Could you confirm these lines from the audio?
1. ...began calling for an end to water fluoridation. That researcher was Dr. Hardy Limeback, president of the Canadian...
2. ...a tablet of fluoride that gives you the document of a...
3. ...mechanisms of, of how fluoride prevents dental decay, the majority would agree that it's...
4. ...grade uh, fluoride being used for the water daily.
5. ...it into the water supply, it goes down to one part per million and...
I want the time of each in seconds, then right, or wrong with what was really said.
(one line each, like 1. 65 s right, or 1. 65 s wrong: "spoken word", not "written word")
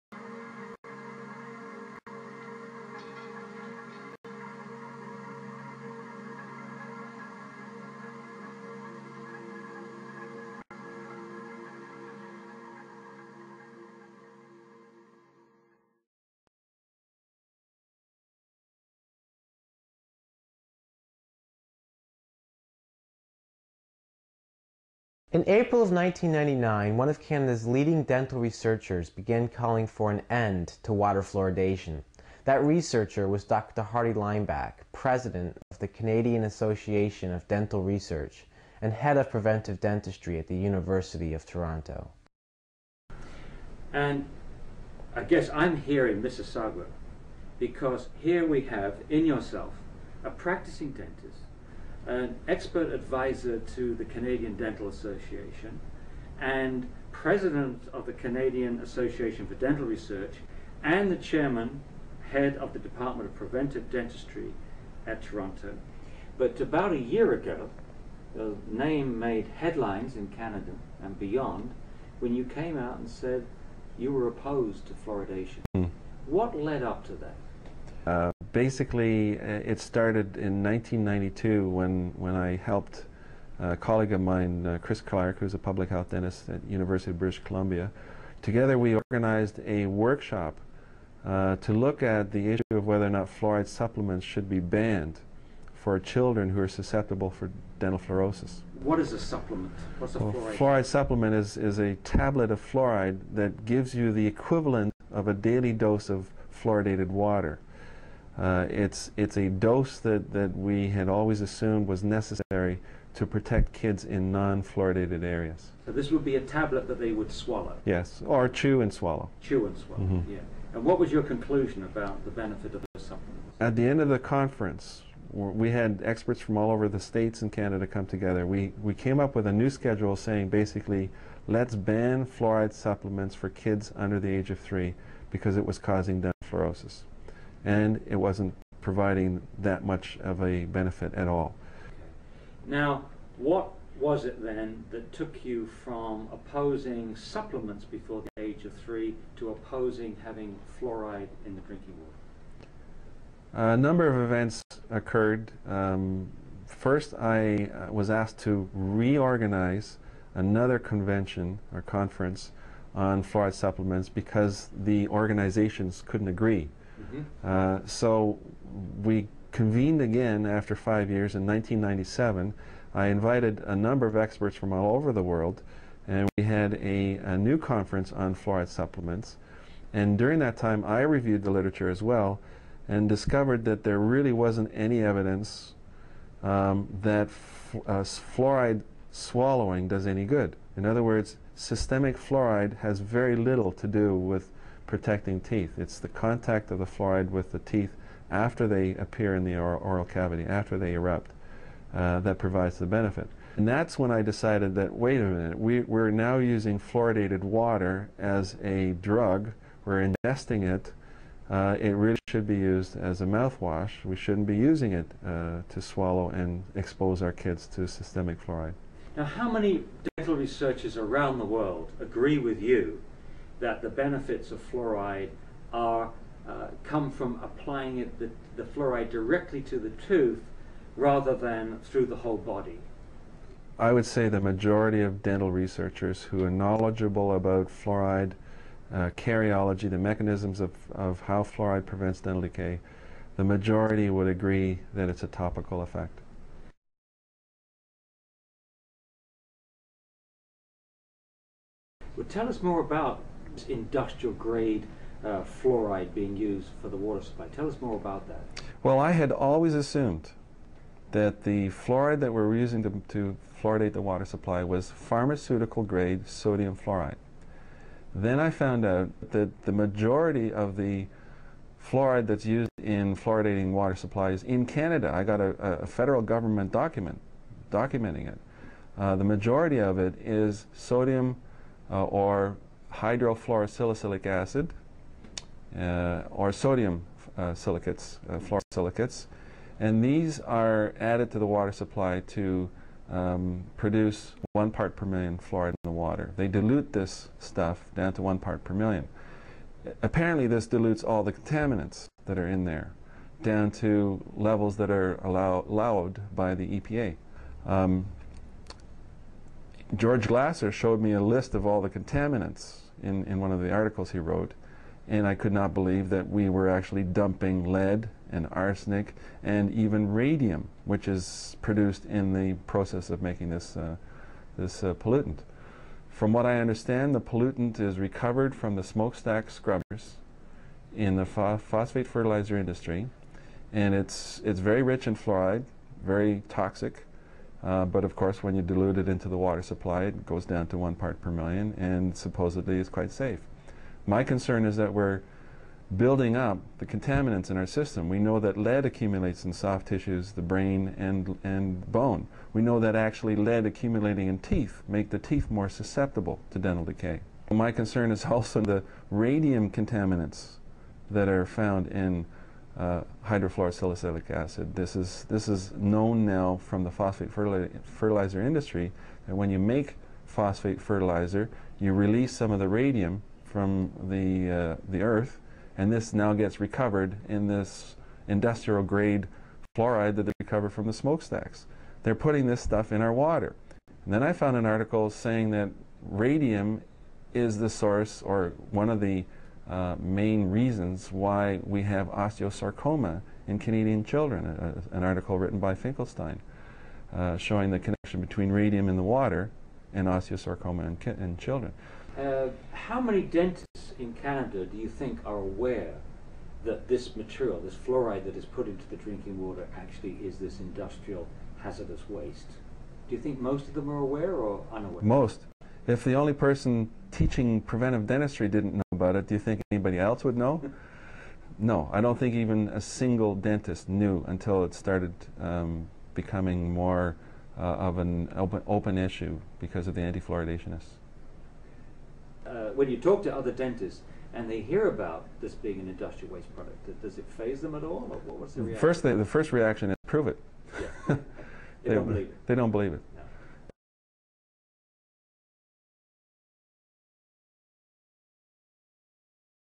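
1. 29 s right
2. 101 s wrong: "equivalent", not "document"
3. 239 s right
4. 254 s wrong: "supply", not "daily"
5. 338 s right.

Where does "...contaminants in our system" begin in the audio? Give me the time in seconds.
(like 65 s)
346 s.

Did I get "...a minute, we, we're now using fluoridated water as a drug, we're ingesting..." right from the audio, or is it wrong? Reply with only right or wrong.
right.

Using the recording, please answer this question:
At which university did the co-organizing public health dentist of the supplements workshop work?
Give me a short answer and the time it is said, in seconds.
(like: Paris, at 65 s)
University of British Columbia, at 86 s.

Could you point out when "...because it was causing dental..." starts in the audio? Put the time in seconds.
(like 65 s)
135 s.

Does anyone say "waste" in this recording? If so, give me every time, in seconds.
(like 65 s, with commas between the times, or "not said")
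412 s, 436 s.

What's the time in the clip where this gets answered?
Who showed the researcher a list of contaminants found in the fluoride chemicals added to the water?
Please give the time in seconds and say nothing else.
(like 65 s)
309 s.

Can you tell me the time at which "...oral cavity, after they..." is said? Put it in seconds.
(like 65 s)
199 s.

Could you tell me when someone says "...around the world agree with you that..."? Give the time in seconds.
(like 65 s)
220 s.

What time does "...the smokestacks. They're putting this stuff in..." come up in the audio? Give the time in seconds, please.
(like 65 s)
380 s.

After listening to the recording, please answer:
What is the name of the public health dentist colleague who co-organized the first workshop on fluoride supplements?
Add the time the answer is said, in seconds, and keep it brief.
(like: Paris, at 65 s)
Chris Clark, at 84 s.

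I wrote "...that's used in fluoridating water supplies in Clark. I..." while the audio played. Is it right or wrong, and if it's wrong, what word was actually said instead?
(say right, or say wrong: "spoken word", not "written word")
wrong: "Canada", not "Clark".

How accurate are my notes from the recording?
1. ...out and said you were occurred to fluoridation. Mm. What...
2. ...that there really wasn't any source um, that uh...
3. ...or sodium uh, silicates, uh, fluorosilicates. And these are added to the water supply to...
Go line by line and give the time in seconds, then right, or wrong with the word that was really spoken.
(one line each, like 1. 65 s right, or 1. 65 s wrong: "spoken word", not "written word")
1. 72 s wrong: "opposed", not "occurred"
2. 183 s wrong: "evidence", not "source"
3. 286 s right.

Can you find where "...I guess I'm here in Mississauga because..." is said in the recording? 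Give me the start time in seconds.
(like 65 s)
45 s.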